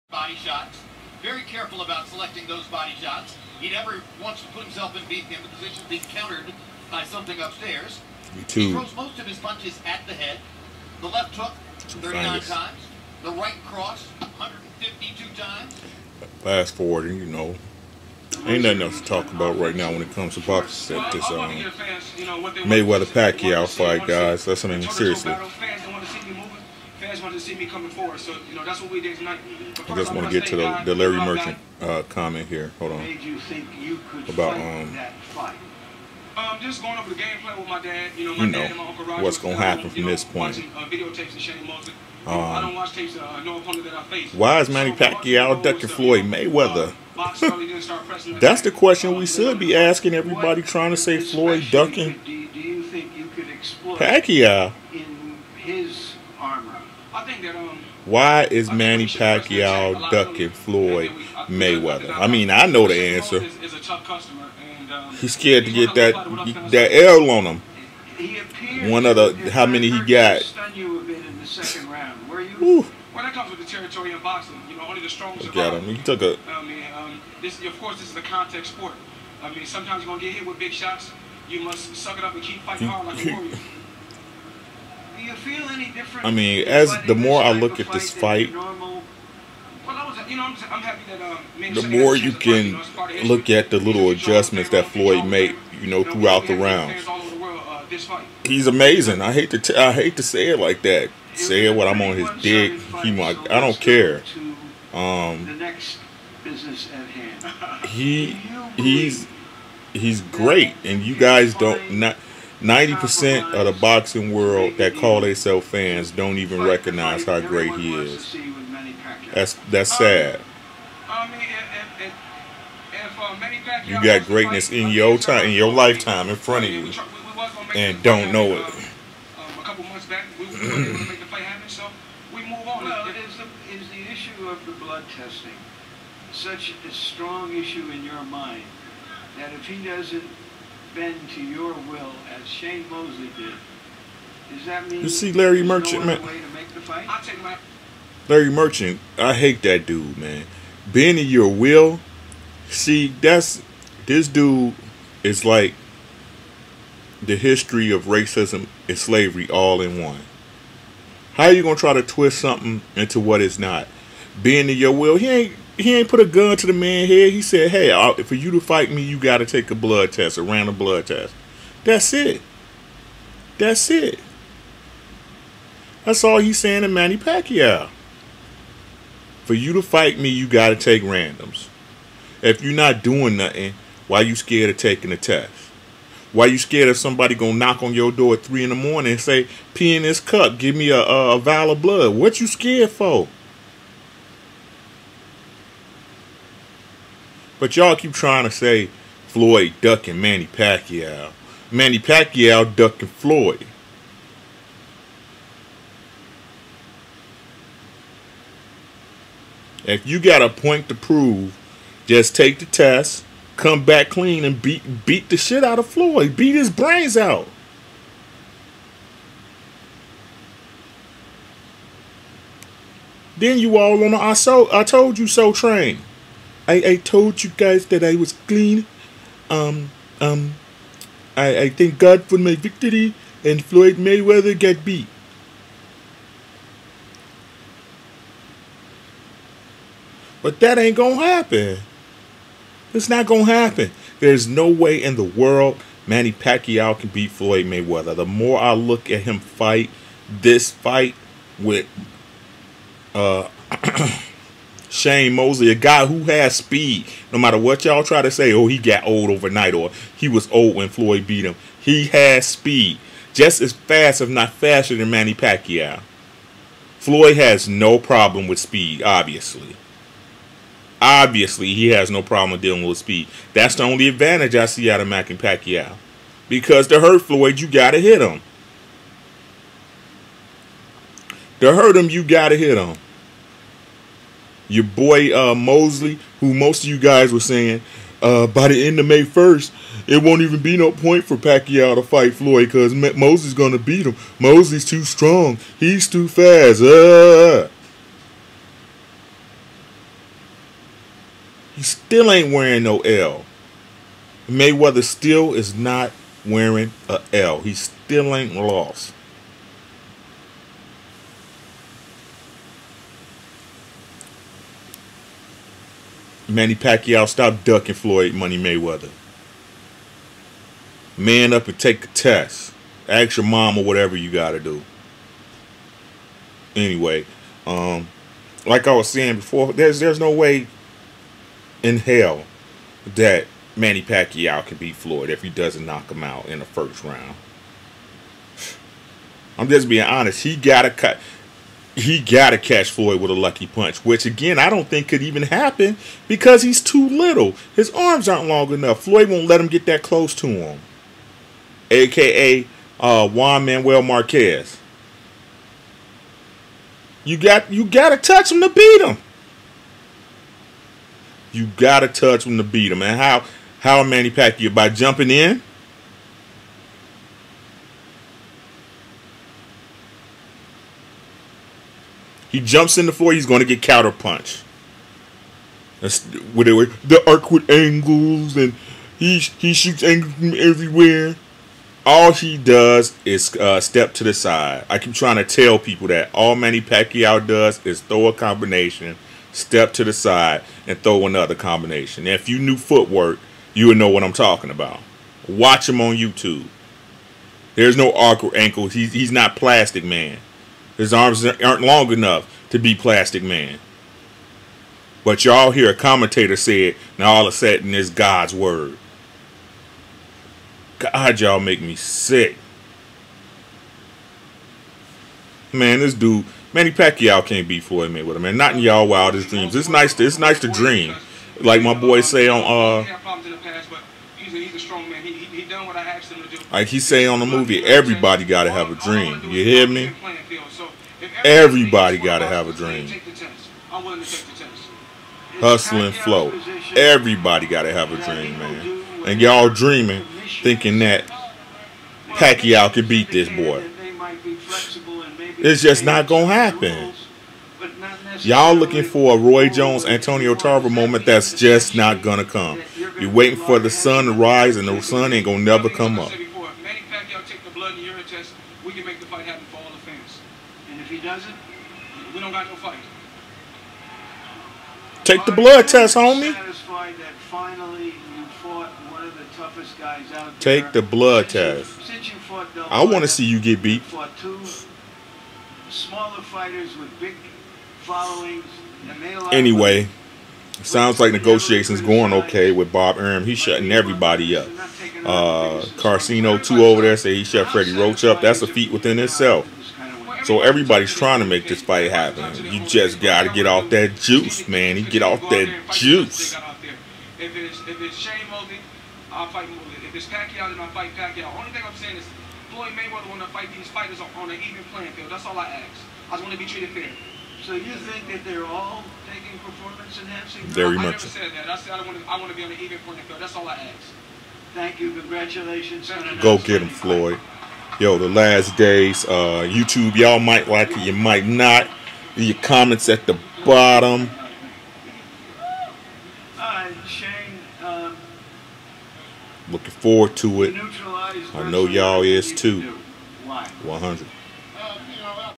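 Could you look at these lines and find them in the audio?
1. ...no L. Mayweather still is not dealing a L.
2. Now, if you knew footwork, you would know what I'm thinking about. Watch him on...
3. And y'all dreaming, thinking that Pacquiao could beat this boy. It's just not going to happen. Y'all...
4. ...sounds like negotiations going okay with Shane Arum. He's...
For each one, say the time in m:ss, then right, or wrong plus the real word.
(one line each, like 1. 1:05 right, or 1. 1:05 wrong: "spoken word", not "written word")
1. 5:02 wrong: "wearing", not "dealing"
2. 6:32 wrong: "talking", not "thinking"
3. 7:19 right
4. 8:00 wrong: "Bob", not "Shane".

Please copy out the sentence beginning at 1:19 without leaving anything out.
I mean, sometimes you're gonna get hit with big shots.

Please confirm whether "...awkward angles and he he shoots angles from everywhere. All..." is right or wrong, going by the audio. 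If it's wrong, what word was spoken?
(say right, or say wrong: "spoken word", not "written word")
right.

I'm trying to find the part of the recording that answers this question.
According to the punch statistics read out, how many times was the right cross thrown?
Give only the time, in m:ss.
0:14.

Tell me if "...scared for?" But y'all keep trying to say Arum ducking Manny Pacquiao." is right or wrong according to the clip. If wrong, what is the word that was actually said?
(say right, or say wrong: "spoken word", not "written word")
wrong: "Floyd", not "Arum".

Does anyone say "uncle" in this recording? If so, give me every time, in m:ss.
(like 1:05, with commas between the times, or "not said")
0:38.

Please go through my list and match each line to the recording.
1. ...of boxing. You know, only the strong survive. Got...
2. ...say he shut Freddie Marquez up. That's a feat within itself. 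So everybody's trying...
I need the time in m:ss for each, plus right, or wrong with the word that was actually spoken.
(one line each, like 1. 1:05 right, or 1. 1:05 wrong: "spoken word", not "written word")
1. 1:14 right
2. 8:07 wrong: "Roach", not "Marquez".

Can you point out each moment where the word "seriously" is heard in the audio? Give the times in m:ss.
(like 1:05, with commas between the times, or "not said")
0:24.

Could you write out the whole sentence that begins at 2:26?
My- Larry Merchant, I hate that dude, man.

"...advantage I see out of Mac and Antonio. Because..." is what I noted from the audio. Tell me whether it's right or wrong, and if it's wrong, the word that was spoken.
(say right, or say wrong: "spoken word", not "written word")
wrong: "Pacquiao", not "Antonio".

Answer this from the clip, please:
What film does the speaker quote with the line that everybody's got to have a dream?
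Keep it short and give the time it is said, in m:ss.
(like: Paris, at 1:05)
Hustle and Flow, at 7:15.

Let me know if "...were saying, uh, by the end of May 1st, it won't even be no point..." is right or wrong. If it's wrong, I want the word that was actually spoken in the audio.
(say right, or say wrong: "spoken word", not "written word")
right.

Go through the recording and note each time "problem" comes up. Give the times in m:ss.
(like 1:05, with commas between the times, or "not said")
4:27, 4:32.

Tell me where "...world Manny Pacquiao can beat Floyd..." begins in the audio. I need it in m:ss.
4:05.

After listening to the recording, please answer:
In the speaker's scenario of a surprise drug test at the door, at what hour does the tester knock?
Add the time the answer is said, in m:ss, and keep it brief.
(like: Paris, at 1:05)
3 in the morning, at 3:08.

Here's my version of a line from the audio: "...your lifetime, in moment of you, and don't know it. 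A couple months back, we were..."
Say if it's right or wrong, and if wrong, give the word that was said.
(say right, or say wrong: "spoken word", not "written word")
wrong: "front", not "moment".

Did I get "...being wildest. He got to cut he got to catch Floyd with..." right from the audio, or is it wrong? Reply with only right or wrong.
wrong.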